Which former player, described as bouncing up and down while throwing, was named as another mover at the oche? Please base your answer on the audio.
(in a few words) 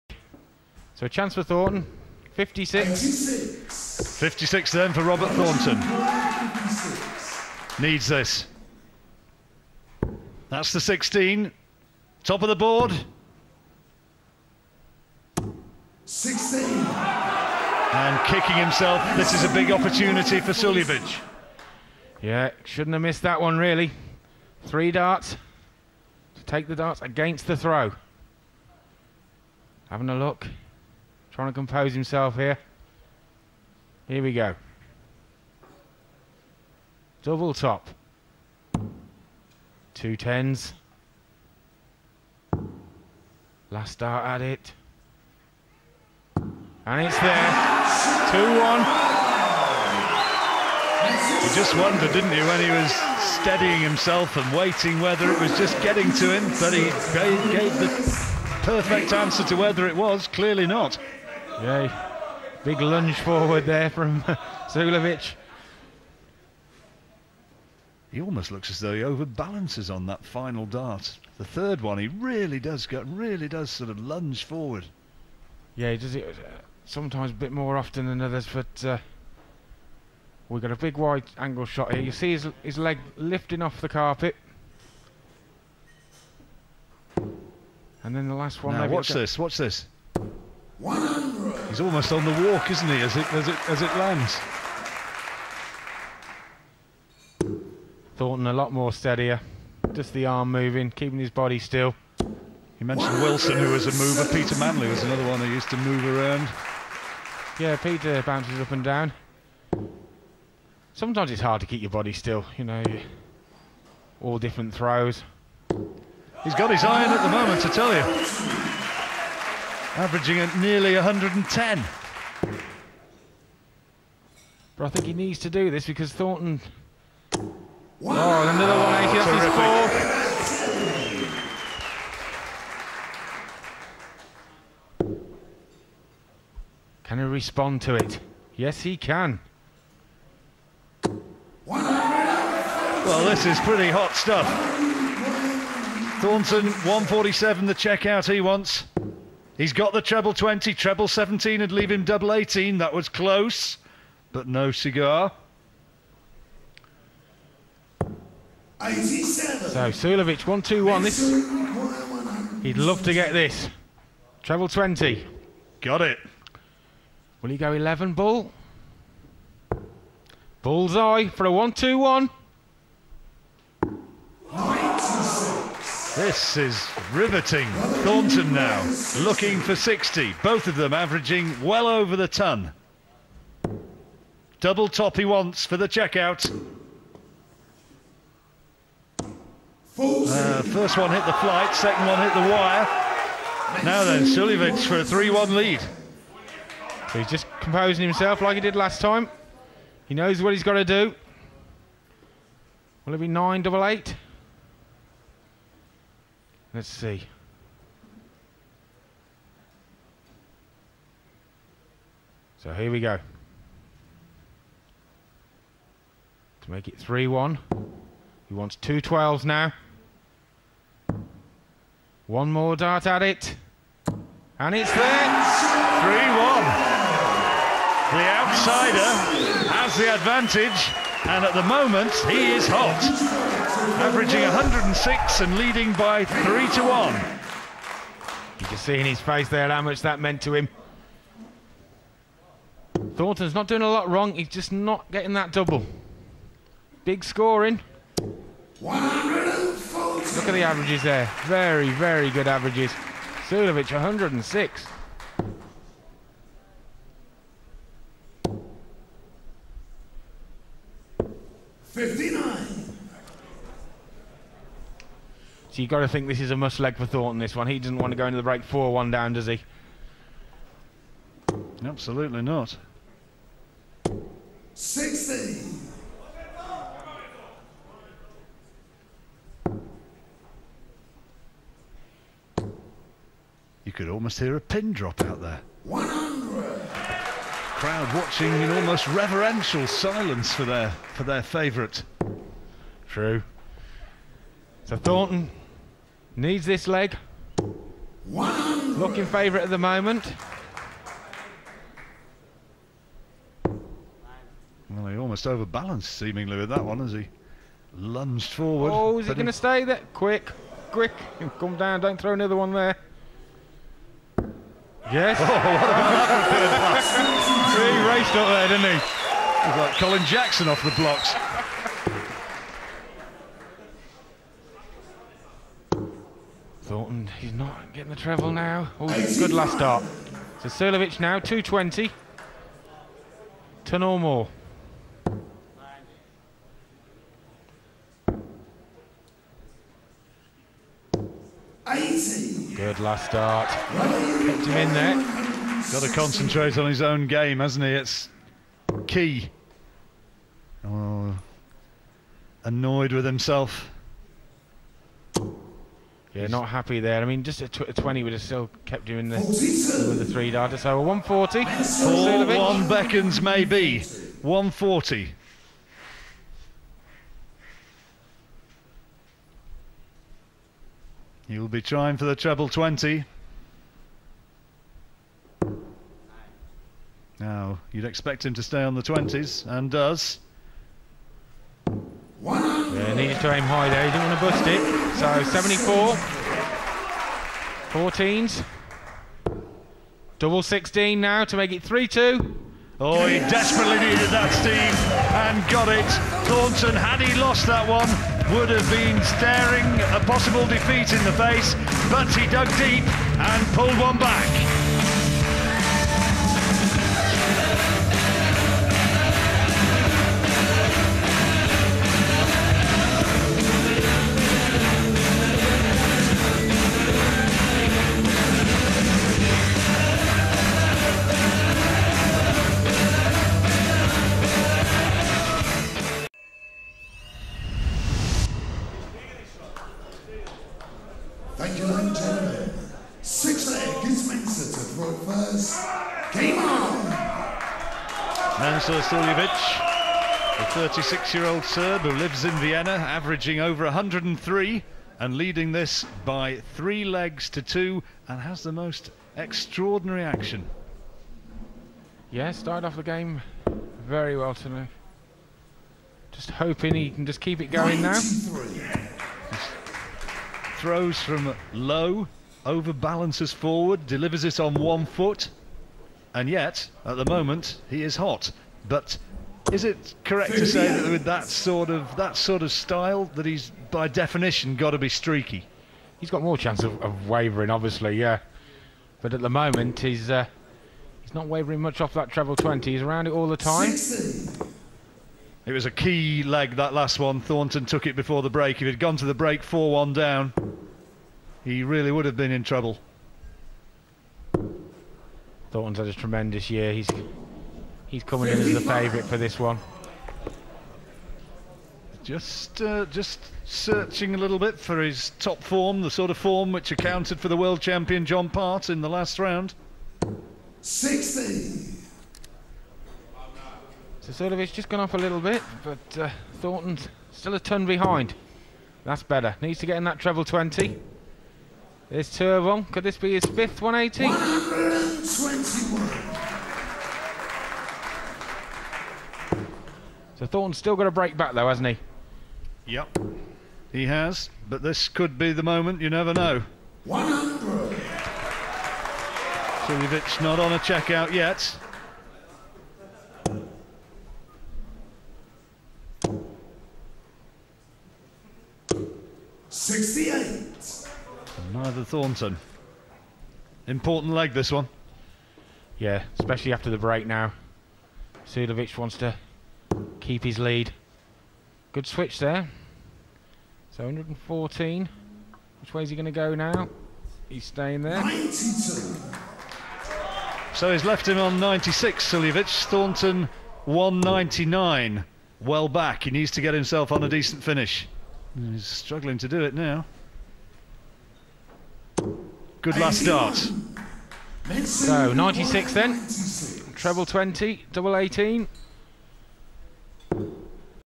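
Peter Manley.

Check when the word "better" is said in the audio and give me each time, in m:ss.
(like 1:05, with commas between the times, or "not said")
8:39.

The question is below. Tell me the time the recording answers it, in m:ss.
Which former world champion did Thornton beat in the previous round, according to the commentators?
8:28.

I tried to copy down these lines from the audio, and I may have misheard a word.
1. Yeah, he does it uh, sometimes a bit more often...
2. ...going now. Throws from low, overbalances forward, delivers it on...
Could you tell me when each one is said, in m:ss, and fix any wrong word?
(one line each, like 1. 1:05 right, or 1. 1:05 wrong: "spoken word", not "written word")
1. 1:15 right
2. 7:37 right.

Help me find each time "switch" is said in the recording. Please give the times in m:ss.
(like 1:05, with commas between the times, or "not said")
9:22.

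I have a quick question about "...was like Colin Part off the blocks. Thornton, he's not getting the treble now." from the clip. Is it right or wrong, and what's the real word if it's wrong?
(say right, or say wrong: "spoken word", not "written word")
wrong: "Jackson", not "Part".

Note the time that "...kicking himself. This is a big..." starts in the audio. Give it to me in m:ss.
0:18.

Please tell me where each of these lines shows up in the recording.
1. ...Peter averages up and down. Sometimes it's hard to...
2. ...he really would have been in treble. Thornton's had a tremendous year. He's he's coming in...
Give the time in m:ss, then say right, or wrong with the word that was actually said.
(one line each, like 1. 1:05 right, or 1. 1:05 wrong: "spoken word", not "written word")
1. 1:47 wrong: "bounces", not "averages"
2. 8:11 wrong: "trouble", not "treble".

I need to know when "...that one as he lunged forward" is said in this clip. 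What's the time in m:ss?
5:06.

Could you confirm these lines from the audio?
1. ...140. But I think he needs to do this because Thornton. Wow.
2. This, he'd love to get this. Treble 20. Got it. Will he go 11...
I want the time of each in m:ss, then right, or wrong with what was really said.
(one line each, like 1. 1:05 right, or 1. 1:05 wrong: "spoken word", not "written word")
1. 2:00 wrong: "110", not "140"
2. 2:41 right.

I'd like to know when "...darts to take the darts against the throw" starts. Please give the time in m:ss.
0:24.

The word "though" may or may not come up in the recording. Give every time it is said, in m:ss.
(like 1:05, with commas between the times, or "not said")
1:08, 8:51.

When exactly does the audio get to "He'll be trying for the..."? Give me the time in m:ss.
6:11.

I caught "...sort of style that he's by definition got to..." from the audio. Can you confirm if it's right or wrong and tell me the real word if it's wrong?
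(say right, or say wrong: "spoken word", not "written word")
right.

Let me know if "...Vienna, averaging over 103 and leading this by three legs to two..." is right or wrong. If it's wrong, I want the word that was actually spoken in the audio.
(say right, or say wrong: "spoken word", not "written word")
right.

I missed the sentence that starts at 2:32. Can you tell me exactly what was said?
That was close, but no cigar.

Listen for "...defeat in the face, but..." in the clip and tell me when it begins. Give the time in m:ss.
6:40.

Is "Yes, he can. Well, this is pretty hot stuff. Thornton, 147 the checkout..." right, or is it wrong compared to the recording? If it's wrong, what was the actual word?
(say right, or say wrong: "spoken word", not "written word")
right.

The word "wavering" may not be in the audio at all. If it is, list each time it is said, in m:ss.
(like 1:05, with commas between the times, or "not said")
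7:57, 8:01.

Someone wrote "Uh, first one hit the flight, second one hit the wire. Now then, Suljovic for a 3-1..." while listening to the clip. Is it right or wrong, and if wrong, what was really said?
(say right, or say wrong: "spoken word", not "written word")
right.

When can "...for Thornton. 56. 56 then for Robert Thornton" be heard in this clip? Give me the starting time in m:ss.
0:01.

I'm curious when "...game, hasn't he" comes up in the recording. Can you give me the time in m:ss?
5:47.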